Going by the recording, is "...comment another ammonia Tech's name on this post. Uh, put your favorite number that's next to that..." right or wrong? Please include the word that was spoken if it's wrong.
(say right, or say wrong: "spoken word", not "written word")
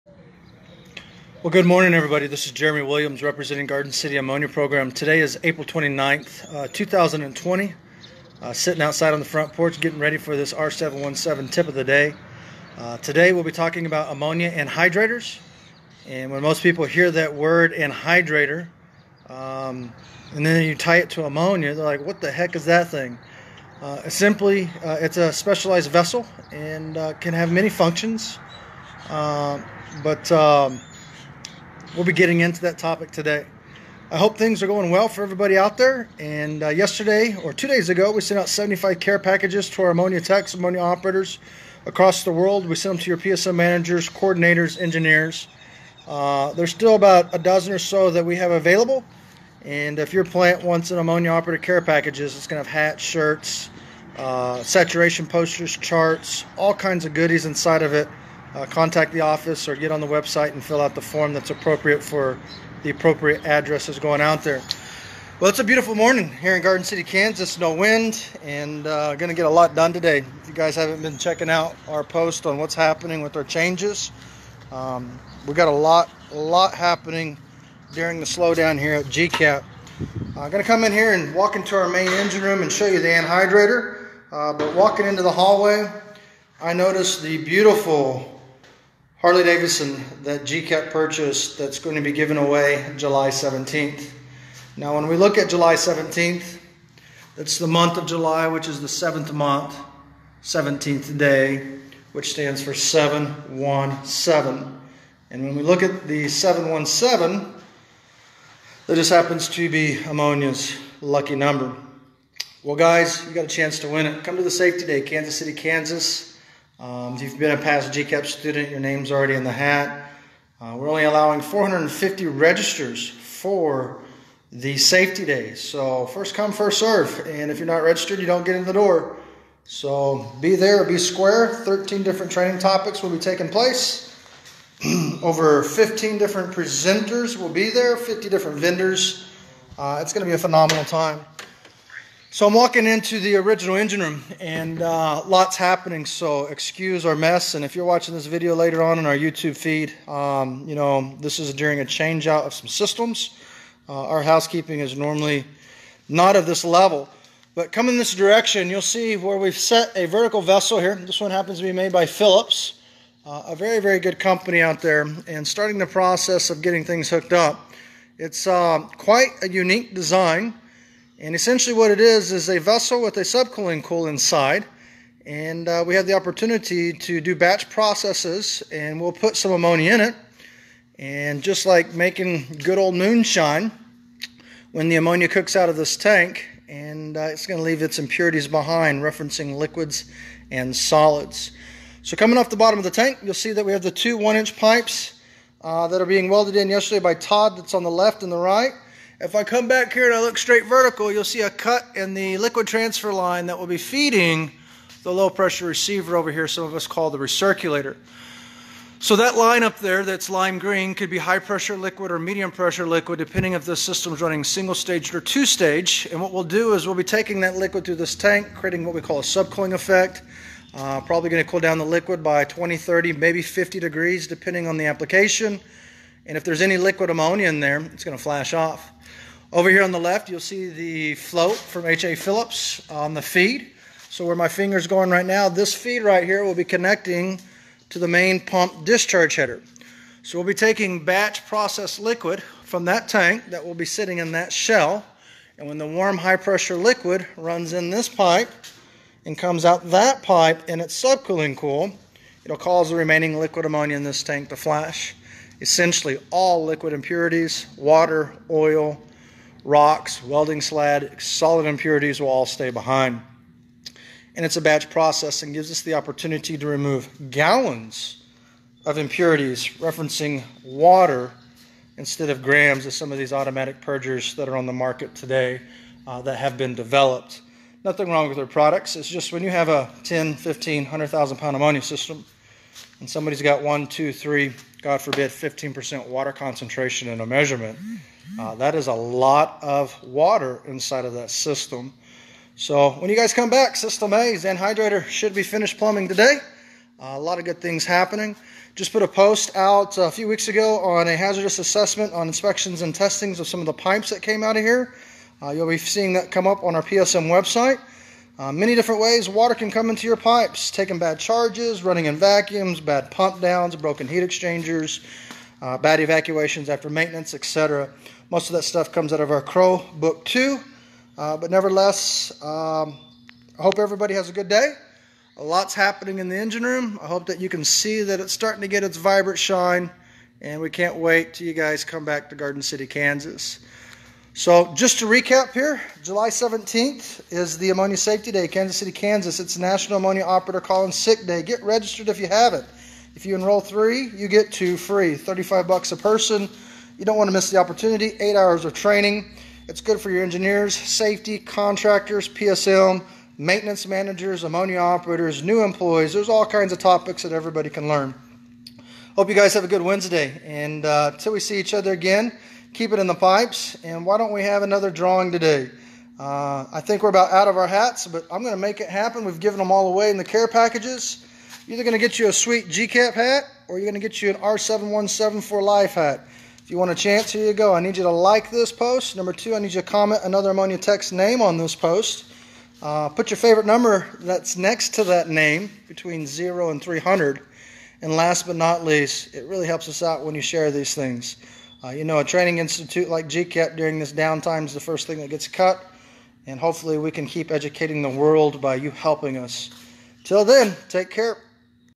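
right.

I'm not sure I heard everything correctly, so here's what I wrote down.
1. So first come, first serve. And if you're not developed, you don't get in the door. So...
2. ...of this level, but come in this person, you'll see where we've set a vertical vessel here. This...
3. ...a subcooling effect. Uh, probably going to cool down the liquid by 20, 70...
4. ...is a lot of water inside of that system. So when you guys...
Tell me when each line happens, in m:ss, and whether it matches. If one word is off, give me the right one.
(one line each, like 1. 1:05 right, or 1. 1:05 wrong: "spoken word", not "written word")
1. 2:05 wrong: "registered", not "developed"
2. 2:36 wrong: "direction", not "person"
3. 3:39 wrong: "30", not "70"
4. 4:48 right.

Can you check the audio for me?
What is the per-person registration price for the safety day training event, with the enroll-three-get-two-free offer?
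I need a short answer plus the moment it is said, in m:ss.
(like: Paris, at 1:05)
$35, at 5:45.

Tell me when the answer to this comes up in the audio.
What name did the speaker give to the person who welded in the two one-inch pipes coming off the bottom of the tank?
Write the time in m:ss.
3:17.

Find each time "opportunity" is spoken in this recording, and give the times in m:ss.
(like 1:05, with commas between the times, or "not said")
2:56, 4:25, 5:47.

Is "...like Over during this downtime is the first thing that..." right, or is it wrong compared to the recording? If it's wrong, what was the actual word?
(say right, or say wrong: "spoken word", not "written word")
wrong: "GCap", not "Over".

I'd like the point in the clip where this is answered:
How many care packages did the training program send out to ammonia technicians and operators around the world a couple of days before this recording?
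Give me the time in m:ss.
0:38.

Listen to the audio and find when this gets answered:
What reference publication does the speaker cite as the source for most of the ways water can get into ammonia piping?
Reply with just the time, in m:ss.
5:19.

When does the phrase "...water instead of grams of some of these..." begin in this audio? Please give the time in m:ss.
4:30.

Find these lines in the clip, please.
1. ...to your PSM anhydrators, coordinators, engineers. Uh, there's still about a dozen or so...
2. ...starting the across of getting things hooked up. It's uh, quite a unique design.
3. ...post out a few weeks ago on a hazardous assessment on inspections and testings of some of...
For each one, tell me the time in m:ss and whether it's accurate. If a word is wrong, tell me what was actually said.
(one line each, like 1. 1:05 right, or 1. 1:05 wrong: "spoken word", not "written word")
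1. 0:43 wrong: "managers", not "anhydrators"
2. 2:45 wrong: "process", not "across"
3. 4:59 right.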